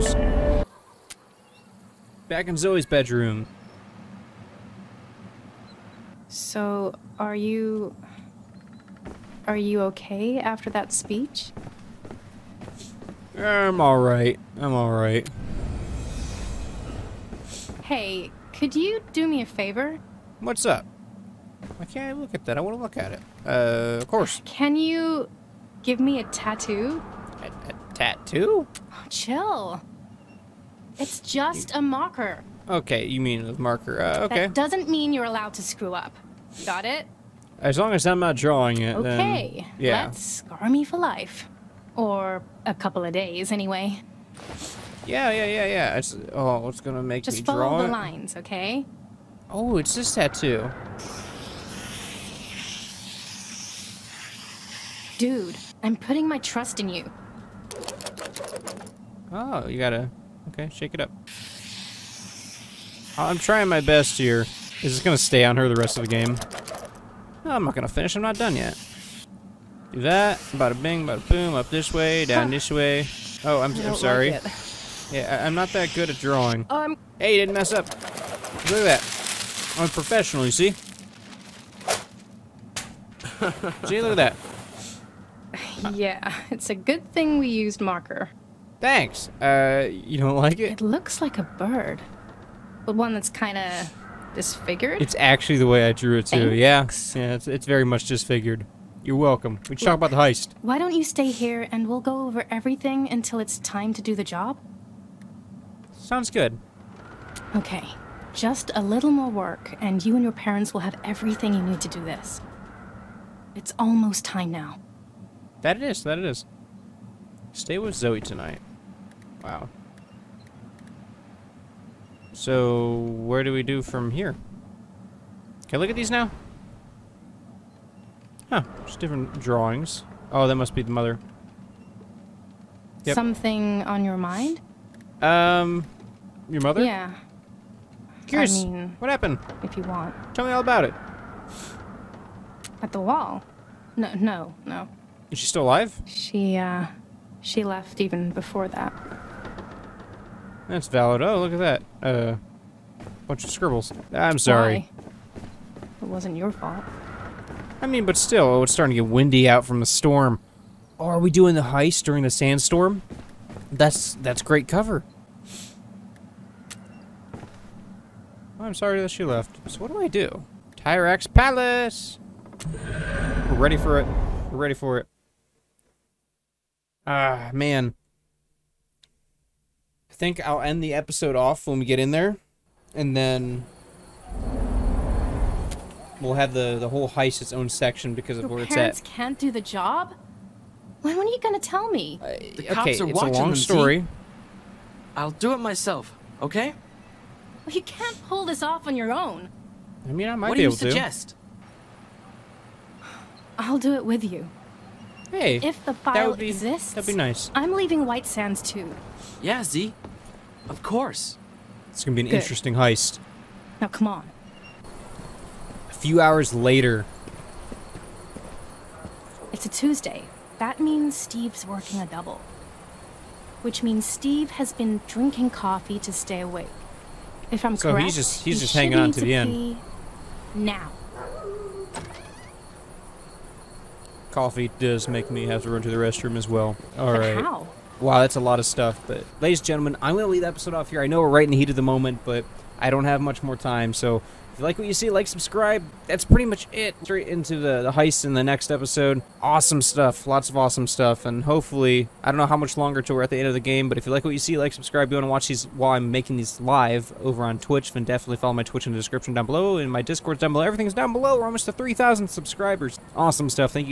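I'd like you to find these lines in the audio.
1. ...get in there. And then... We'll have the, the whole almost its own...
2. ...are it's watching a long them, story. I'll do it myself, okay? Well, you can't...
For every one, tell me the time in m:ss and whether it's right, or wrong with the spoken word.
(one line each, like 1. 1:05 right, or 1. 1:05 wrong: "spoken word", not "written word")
1. 3:01 wrong: "heist", not "almost"
2. 3:13 right.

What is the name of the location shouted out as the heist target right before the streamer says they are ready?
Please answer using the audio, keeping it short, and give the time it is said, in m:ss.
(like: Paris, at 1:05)
Tyrax Palace, at 2:50.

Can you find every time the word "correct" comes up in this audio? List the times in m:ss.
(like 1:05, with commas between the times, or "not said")
3:47.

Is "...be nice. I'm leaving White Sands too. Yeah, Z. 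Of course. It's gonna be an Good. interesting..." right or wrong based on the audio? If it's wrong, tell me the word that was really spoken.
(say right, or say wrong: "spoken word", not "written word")
right.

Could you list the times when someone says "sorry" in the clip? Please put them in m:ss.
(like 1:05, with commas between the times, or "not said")
1:13, 2:34, 2:48.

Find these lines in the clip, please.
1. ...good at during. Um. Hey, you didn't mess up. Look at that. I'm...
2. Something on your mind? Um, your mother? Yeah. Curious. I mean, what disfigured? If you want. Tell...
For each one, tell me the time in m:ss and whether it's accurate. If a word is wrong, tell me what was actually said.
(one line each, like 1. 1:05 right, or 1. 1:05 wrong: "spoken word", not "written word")
1. 1:15 wrong: "drawing", not "during"
2. 2:13 wrong: "happened", not "disfigured".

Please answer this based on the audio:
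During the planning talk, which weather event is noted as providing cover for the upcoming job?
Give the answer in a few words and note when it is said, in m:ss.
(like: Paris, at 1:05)
Sandstorm, at 2:42.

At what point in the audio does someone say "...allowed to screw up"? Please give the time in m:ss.
0:35.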